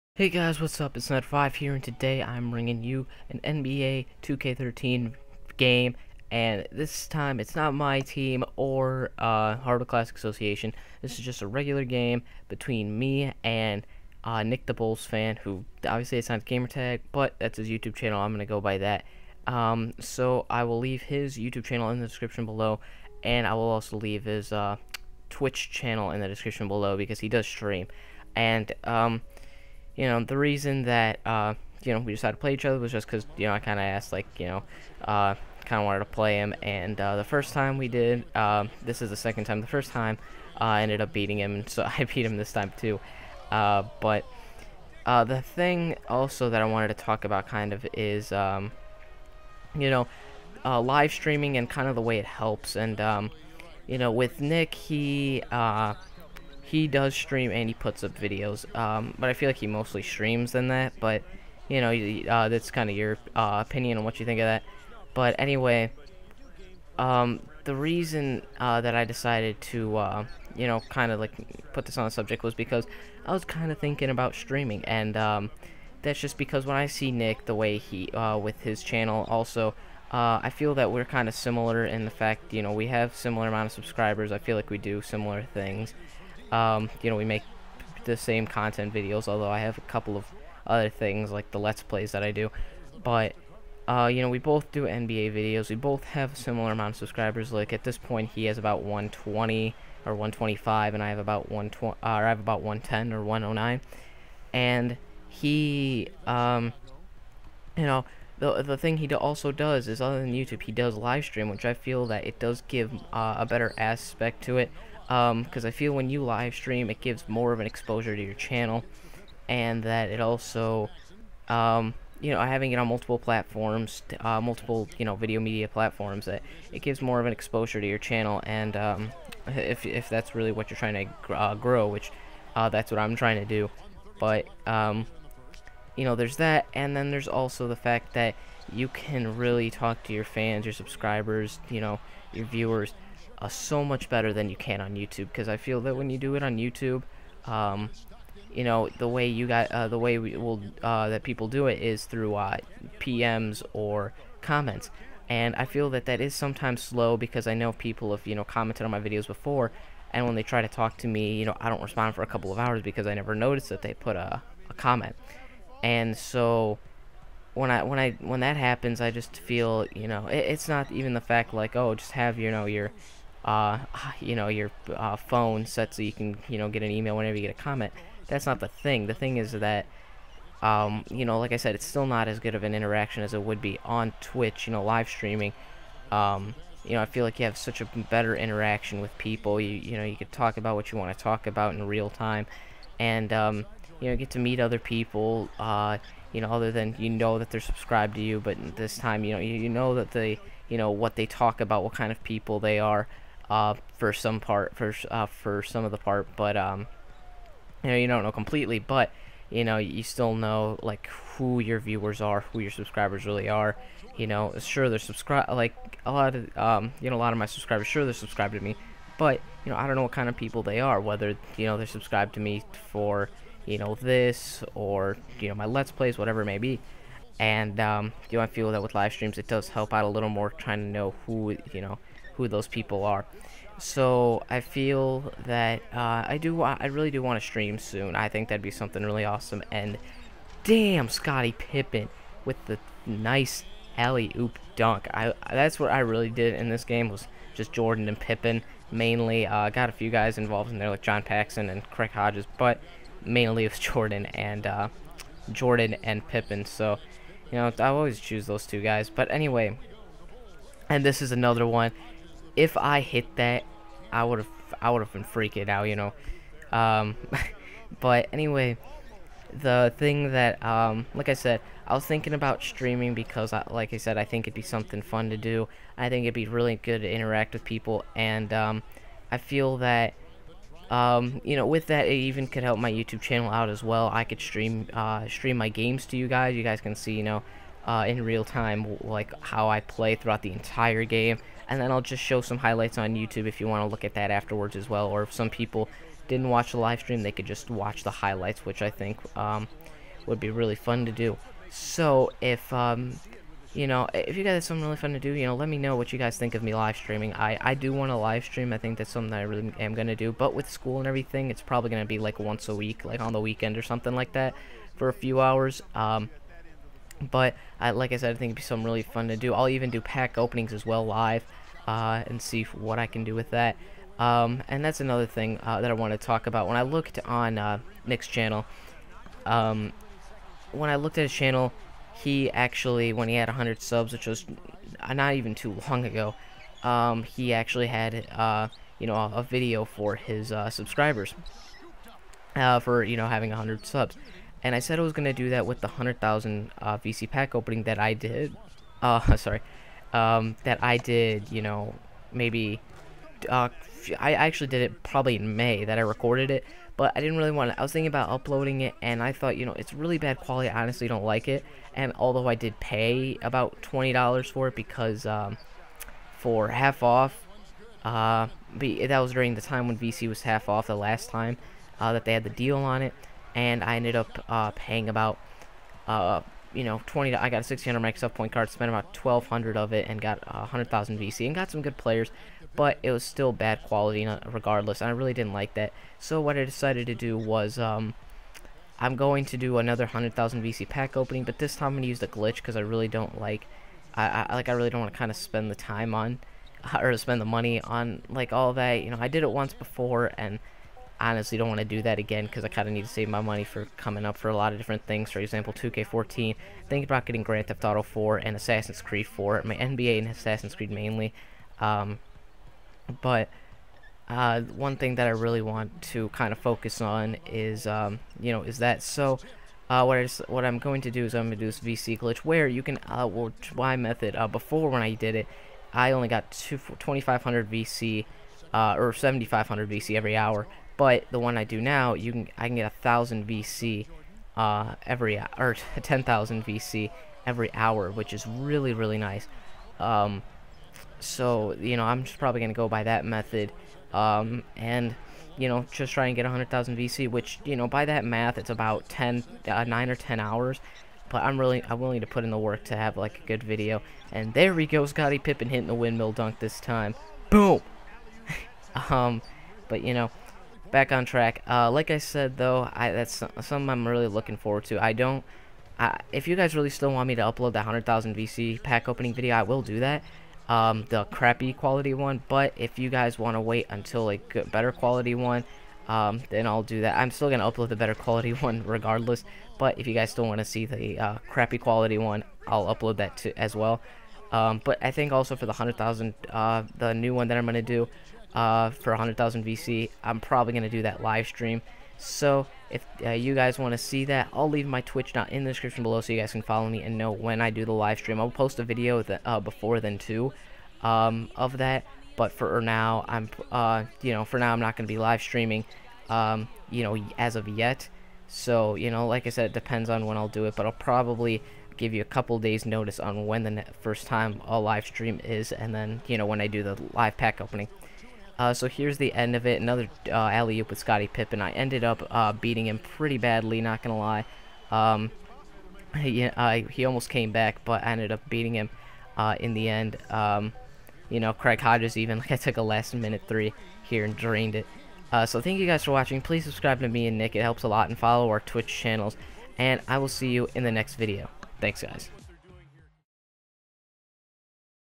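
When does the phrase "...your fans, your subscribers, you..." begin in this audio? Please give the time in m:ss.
2:20.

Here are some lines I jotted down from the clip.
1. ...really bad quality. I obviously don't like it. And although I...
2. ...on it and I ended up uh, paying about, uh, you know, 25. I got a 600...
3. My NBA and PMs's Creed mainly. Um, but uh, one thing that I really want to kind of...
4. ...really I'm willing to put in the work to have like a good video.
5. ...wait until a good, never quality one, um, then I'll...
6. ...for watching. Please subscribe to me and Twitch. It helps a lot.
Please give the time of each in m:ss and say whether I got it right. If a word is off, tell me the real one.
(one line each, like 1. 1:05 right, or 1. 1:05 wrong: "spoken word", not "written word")
1. 5:59 wrong: "honestly", not "obviously"
2. 6:12 wrong: "20", not "25"
3. 6:49 wrong: "Assassin", not "PMs"
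4. 7:31 right
5. 7:53 wrong: "better", not "never"
6. 8:56 wrong: "Nick", not "Twitch".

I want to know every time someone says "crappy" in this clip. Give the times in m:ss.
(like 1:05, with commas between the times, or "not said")
7:51, 8:01.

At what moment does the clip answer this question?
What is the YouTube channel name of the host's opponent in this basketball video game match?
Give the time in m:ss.
0:14.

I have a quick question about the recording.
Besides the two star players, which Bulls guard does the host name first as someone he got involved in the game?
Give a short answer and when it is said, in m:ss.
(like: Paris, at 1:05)
John Paxson, at 4:11.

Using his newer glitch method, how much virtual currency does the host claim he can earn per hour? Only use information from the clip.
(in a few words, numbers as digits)
10,000 VC.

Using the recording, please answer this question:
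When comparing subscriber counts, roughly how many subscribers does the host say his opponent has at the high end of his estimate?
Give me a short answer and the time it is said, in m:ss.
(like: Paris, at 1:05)
125, at 1:40.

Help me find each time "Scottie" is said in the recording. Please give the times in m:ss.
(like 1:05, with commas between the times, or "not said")
4:01, 7:35, 8:40.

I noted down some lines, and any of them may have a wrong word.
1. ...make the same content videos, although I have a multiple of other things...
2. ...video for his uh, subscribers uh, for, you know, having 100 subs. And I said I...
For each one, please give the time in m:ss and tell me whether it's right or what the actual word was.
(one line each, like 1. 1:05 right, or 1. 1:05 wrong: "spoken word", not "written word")
1. 1:27 wrong: "couple", not "multiple"
2. 5:39 right.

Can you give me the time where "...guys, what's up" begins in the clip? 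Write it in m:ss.
0:00.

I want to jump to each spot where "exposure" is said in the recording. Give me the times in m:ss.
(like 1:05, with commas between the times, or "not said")
1:57, 2:07.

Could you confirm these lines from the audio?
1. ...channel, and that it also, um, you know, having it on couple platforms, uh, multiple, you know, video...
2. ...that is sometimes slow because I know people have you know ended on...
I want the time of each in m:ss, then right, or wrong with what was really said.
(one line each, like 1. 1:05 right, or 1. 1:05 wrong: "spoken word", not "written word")
1. 1:58 wrong: "multiple", not "couple"
2. 2:36 wrong: "commented", not "ended".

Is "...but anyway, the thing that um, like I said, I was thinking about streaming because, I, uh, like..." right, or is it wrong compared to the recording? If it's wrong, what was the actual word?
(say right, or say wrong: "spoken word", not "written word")
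right.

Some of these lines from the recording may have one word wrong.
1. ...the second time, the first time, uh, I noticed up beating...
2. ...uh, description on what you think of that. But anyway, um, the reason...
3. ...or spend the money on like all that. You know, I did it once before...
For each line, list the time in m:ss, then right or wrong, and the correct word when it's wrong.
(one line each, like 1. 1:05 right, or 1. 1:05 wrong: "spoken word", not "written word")
1. 0:39 wrong: "ended", not "noticed"
2. 1:03 wrong: "opinion", not "description"
3. 6:36 right.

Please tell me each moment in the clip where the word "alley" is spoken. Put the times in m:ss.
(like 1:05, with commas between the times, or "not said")
4:03, 8:40.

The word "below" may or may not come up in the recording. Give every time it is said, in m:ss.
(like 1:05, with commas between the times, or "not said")
0:22, 0:26, 8:16.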